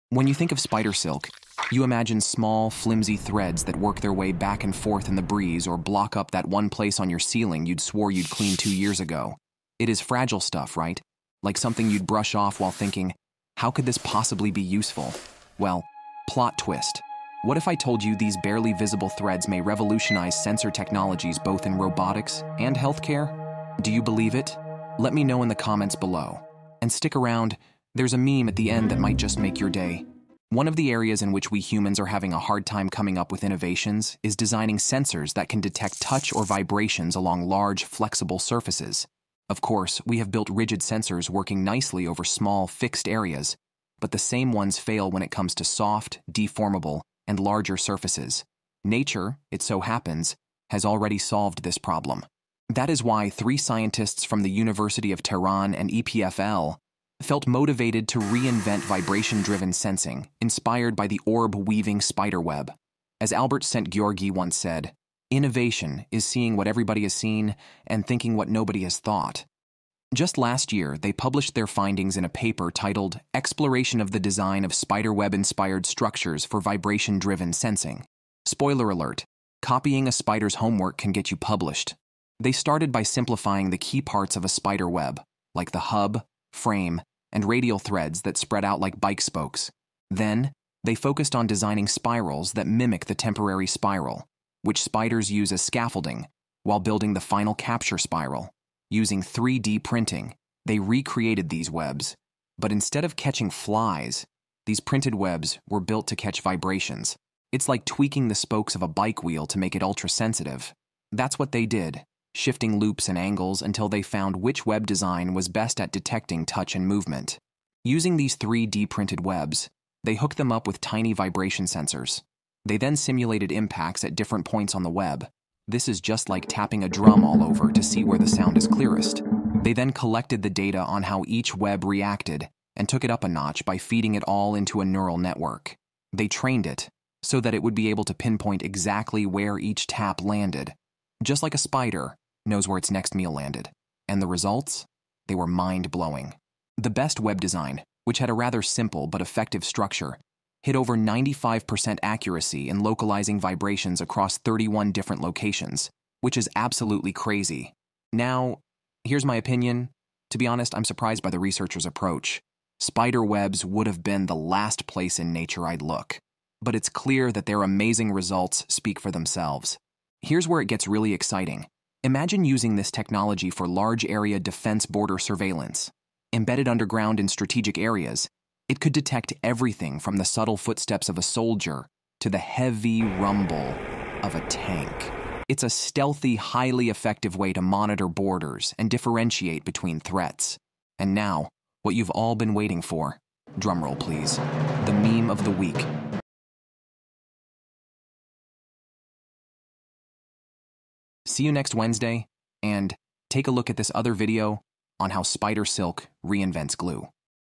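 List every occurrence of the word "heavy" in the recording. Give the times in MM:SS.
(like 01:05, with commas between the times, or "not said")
03:02.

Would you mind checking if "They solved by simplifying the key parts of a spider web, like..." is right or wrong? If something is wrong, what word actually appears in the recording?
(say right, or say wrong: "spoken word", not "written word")
wrong: "started", not "solved".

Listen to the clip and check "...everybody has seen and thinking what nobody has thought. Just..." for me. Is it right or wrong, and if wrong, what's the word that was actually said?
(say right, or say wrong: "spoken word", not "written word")
right.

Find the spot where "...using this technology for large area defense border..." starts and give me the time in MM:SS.
02:52.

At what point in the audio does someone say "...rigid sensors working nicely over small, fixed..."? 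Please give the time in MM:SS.
00:40.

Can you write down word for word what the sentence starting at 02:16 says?
They trained it so that it would be able to pinpoint exactly where each tap landed.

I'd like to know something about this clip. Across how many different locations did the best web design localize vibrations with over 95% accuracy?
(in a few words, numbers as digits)
31.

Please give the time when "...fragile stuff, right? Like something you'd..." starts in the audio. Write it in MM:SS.
00:10.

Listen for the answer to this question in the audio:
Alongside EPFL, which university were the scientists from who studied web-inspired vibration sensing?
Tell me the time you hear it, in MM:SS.
00:54.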